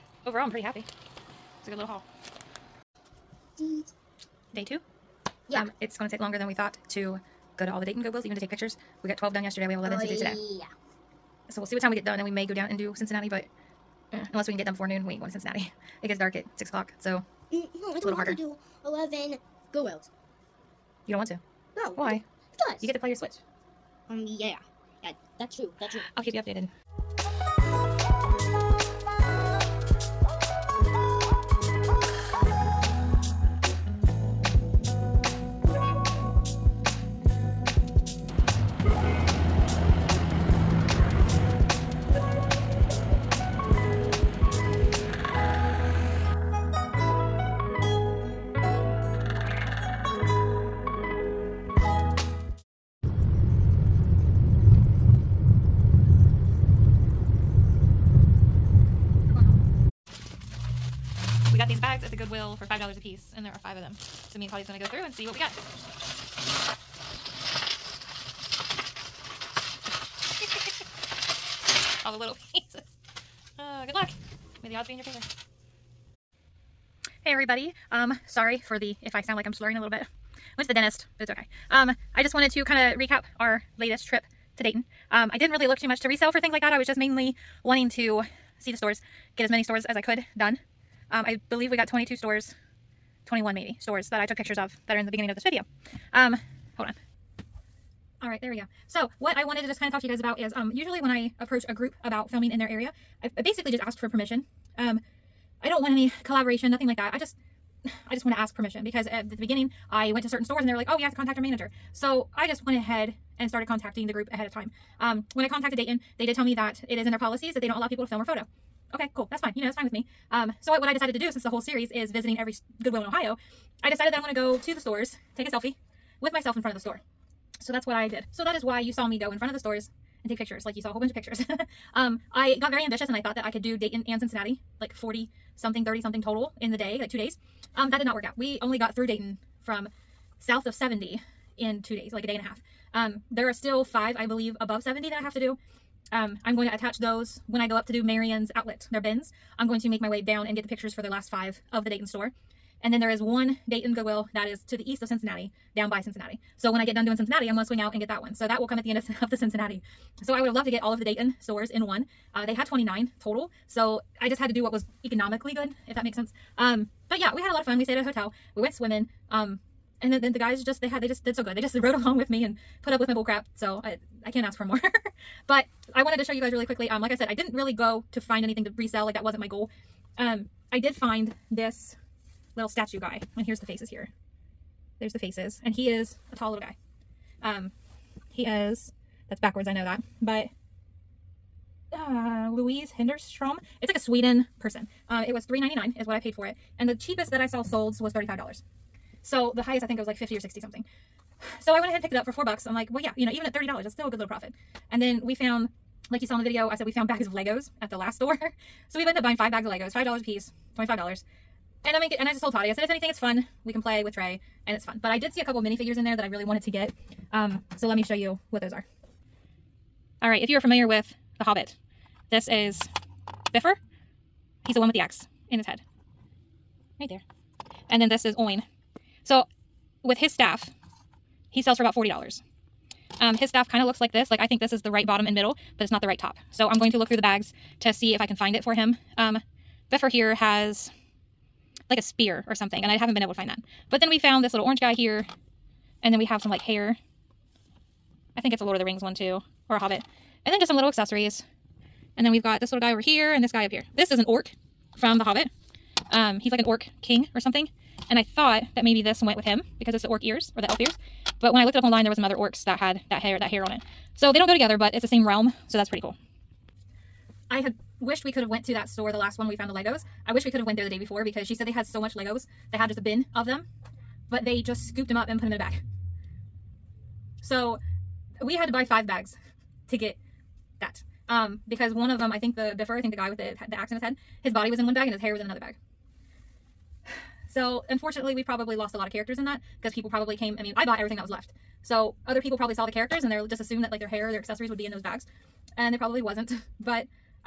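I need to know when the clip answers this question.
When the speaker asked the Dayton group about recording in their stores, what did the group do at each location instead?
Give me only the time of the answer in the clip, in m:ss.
2:05.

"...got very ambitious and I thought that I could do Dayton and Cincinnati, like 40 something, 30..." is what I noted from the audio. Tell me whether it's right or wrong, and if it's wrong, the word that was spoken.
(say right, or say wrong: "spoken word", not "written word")
right.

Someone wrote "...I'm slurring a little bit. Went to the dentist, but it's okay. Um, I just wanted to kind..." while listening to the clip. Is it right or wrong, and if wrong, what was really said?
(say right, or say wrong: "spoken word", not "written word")
right.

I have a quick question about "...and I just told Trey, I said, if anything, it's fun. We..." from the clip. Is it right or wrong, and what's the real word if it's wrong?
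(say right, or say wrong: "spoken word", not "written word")
wrong: "Toddy", not "Trey".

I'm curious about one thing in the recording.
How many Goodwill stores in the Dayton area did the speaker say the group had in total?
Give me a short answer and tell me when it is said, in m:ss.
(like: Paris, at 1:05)
29, at 2:42.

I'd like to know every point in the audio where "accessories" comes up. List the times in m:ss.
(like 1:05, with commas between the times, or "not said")
4:10, 4:54.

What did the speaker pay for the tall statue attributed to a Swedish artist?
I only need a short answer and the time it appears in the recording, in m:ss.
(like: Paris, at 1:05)
$3.99, at 3:15.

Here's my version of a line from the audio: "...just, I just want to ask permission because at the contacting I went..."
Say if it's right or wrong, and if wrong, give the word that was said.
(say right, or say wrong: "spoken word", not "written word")
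wrong: "beginning", not "contacting".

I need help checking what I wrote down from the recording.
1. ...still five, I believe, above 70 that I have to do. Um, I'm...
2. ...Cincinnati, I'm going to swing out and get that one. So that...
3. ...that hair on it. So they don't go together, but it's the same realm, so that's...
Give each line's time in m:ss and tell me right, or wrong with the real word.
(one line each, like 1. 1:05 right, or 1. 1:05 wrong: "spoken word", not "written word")
1. 2:23 right
2. 2:37 right
3. 4:23 right.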